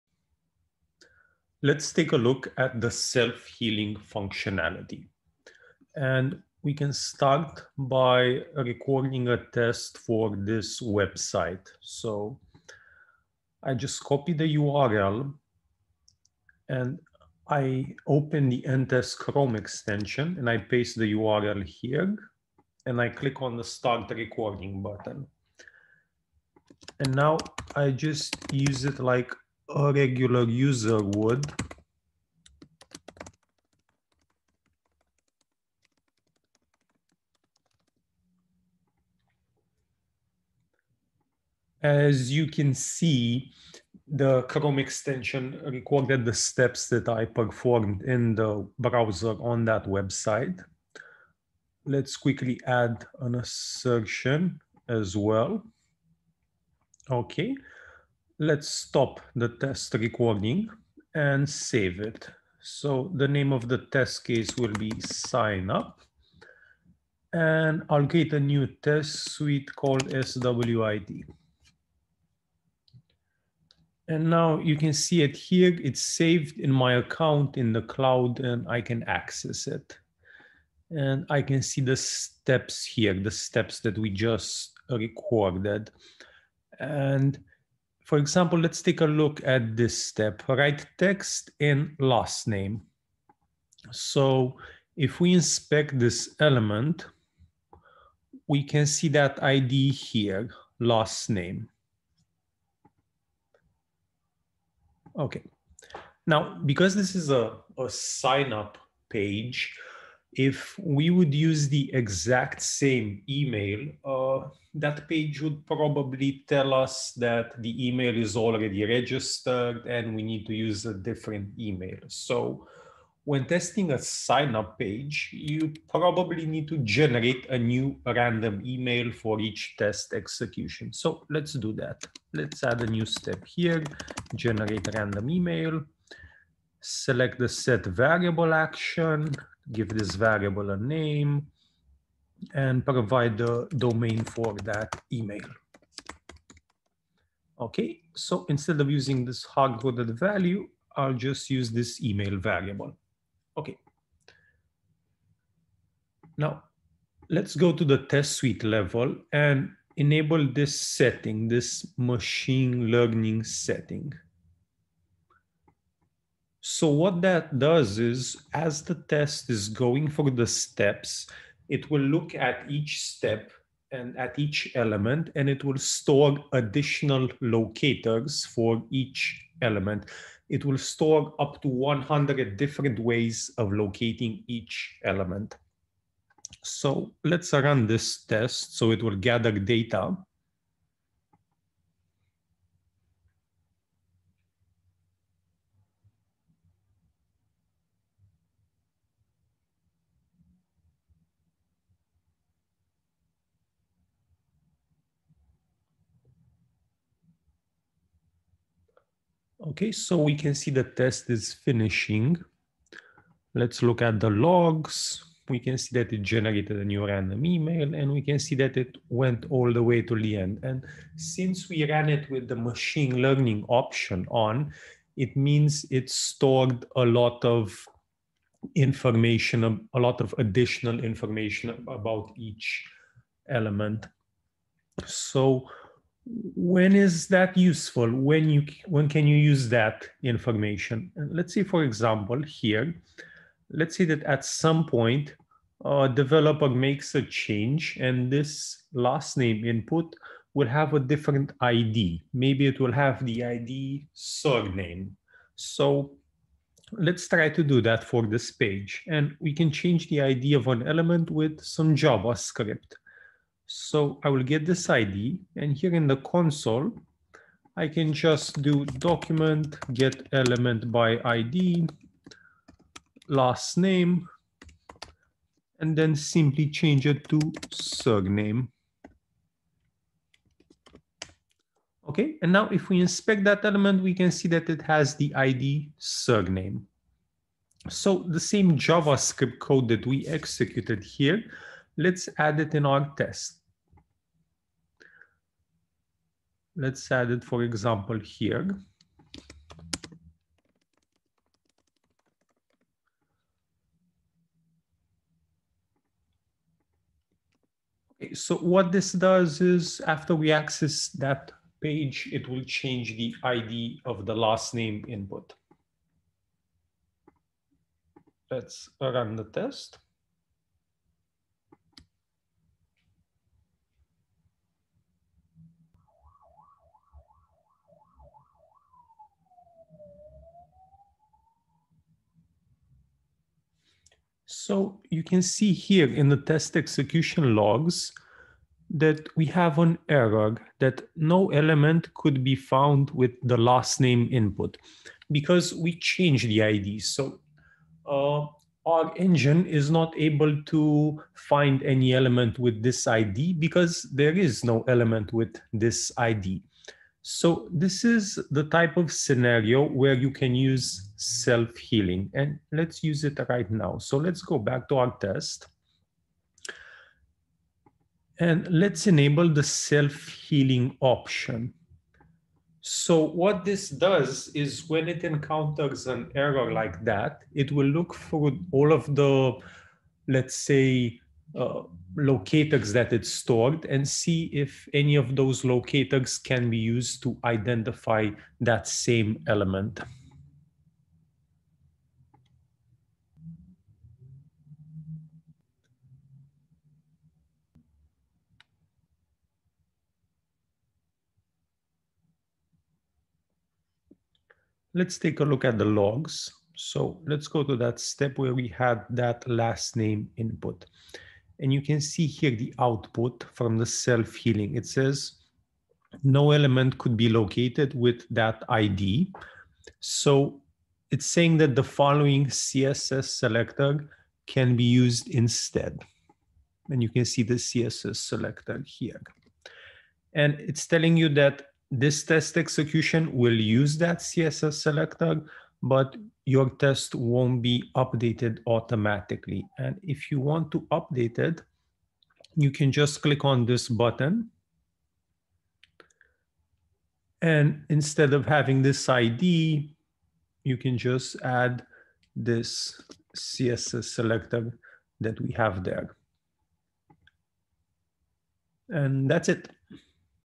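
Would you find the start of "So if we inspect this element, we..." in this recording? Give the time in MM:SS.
01:33.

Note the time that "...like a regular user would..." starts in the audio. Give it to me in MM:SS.
00:28.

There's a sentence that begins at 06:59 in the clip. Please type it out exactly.
So it's saying that the following CSS selector can be used instead.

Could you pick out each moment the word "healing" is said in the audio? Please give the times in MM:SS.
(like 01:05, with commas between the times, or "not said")
00:02, 06:01, 06:09, 06:53.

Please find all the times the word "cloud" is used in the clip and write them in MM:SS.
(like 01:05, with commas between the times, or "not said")
01:17.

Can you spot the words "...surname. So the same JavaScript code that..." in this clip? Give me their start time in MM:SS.
04:45.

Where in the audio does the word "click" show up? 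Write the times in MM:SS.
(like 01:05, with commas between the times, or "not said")
00:23, 07:23.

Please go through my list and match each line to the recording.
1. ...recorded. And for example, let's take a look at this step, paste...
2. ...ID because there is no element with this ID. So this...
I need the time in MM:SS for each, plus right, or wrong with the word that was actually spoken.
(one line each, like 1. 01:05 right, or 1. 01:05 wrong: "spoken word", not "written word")
1. 01:24 wrong: "write", not "paste"
2. 05:53 right.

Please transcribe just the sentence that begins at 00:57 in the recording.
Okay, Let's stop the test recording and save it.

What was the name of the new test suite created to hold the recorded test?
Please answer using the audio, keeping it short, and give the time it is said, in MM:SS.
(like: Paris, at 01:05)
SWID, at 01:10.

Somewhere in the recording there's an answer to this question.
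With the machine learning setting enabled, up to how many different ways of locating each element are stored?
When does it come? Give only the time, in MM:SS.
03:01.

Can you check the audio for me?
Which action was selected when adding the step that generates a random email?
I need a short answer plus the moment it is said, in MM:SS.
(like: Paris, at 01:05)
set variable, at 02:17.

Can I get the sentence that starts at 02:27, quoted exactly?
Okay, so instead of using this hard-coded value, I'll just use this email variable.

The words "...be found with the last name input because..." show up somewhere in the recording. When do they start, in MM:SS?
05:42.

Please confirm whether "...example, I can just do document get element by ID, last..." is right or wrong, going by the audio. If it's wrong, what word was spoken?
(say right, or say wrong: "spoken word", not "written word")
wrong: "console", not "example".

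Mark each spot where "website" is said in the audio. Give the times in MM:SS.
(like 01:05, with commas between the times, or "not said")
00:10, 00:49.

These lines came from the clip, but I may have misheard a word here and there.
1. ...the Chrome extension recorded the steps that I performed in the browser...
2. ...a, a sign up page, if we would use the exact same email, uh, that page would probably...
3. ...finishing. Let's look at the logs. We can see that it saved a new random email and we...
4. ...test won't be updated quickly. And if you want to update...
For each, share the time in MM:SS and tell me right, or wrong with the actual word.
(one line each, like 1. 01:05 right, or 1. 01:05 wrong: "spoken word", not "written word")
1. 00:44 right
2. 01:47 right
3. 03:31 wrong: "generated", not "saved"
4. 07:16 wrong: "automatically", not "quickly".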